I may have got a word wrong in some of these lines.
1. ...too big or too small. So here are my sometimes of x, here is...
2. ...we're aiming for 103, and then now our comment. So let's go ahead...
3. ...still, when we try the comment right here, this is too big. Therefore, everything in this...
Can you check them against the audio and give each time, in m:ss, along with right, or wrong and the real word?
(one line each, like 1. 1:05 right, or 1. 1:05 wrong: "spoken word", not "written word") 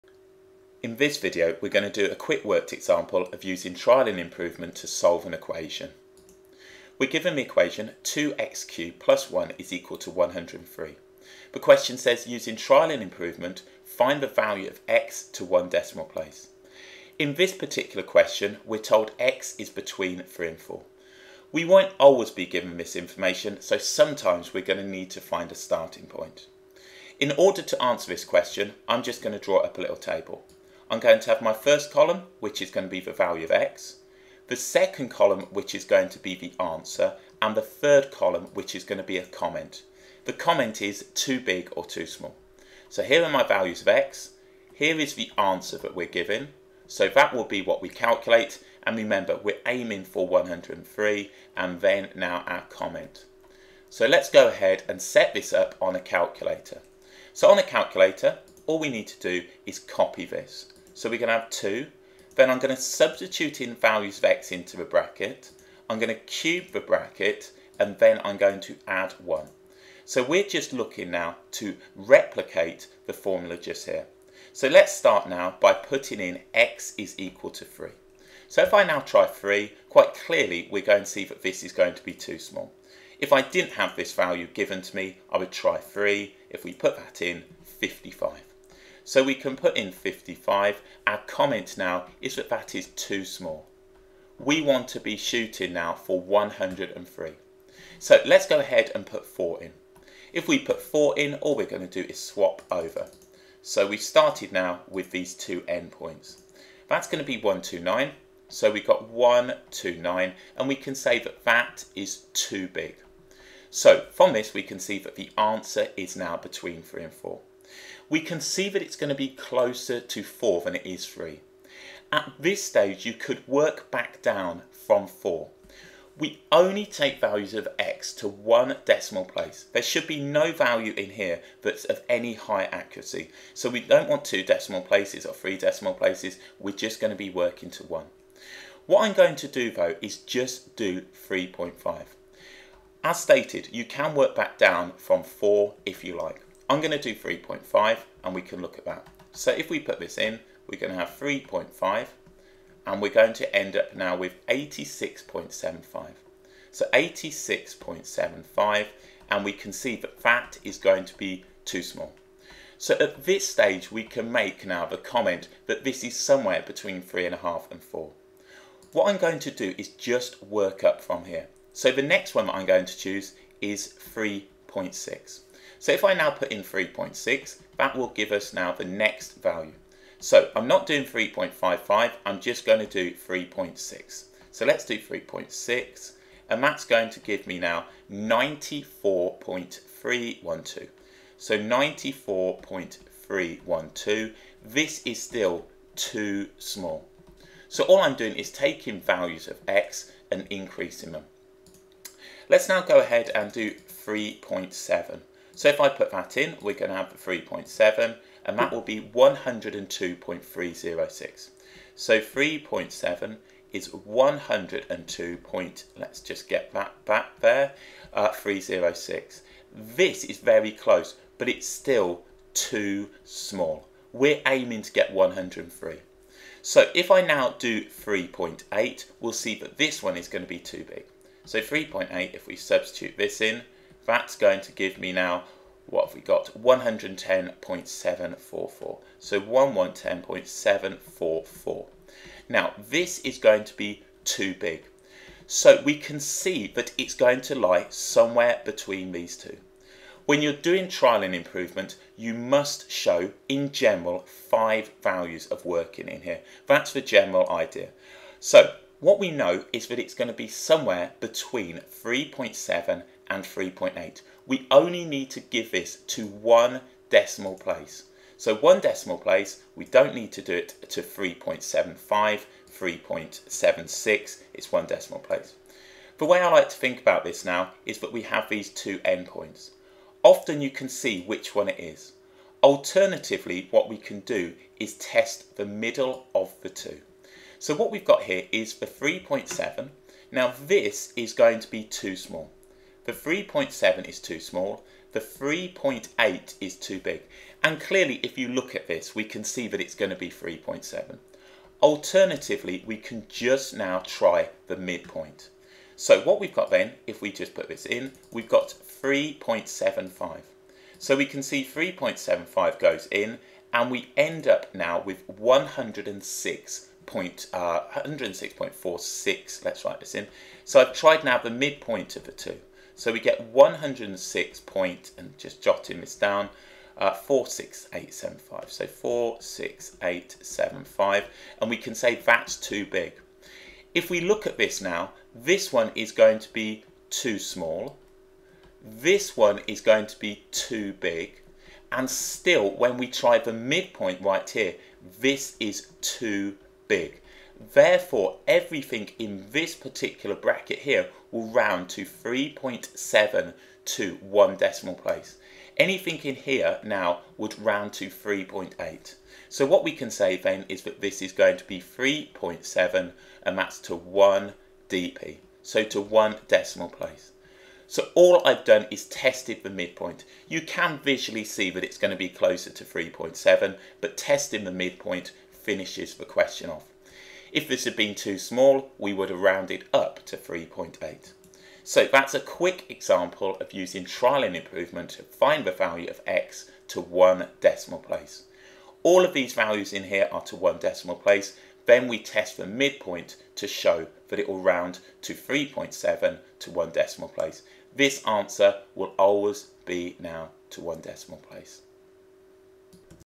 1. 0:41 wrong: "values", not "sometimes"
2. 0:49 right
3. 5:42 wrong: "midpoint", not "comment".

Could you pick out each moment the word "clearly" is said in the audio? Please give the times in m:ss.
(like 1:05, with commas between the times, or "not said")
1:20, 4:57.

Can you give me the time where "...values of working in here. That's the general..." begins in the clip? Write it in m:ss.
4:15.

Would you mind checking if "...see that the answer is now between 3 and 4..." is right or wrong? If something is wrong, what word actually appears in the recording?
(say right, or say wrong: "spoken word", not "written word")
right.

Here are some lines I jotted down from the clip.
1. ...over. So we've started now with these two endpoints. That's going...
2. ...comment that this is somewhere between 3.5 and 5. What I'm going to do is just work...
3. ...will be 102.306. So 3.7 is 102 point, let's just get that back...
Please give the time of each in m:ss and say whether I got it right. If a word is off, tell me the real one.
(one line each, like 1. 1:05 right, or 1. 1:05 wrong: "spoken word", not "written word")
1. 1:42 right
2. 2:44 wrong: "4", not "5"
3. 3:28 right.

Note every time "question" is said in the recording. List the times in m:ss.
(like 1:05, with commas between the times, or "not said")
0:11, 0:18, 0:28, 6:16.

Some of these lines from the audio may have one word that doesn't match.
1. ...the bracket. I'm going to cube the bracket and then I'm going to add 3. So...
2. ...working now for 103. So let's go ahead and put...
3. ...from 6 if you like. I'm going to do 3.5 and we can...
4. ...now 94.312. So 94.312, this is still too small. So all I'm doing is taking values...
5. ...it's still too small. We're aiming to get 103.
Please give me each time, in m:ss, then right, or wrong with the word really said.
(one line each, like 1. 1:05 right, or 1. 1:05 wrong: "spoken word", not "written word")
1. 1:04 wrong: "1", not "3"
2. 1:35 wrong: "shooting", not "working"
3. 2:24 wrong: "4", not "6"
4. 3:07 right
5. 3:41 right.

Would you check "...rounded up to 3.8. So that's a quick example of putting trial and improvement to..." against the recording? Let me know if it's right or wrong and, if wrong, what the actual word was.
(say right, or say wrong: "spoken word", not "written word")
wrong: "using", not "putting".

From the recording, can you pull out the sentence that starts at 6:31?
Then we test the midpoint to show that it will round to 3.7 to one decimal place.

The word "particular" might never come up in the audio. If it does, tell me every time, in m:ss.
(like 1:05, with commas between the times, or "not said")
0:17, 5:49.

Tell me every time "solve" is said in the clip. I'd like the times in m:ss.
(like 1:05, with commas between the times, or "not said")
0:04.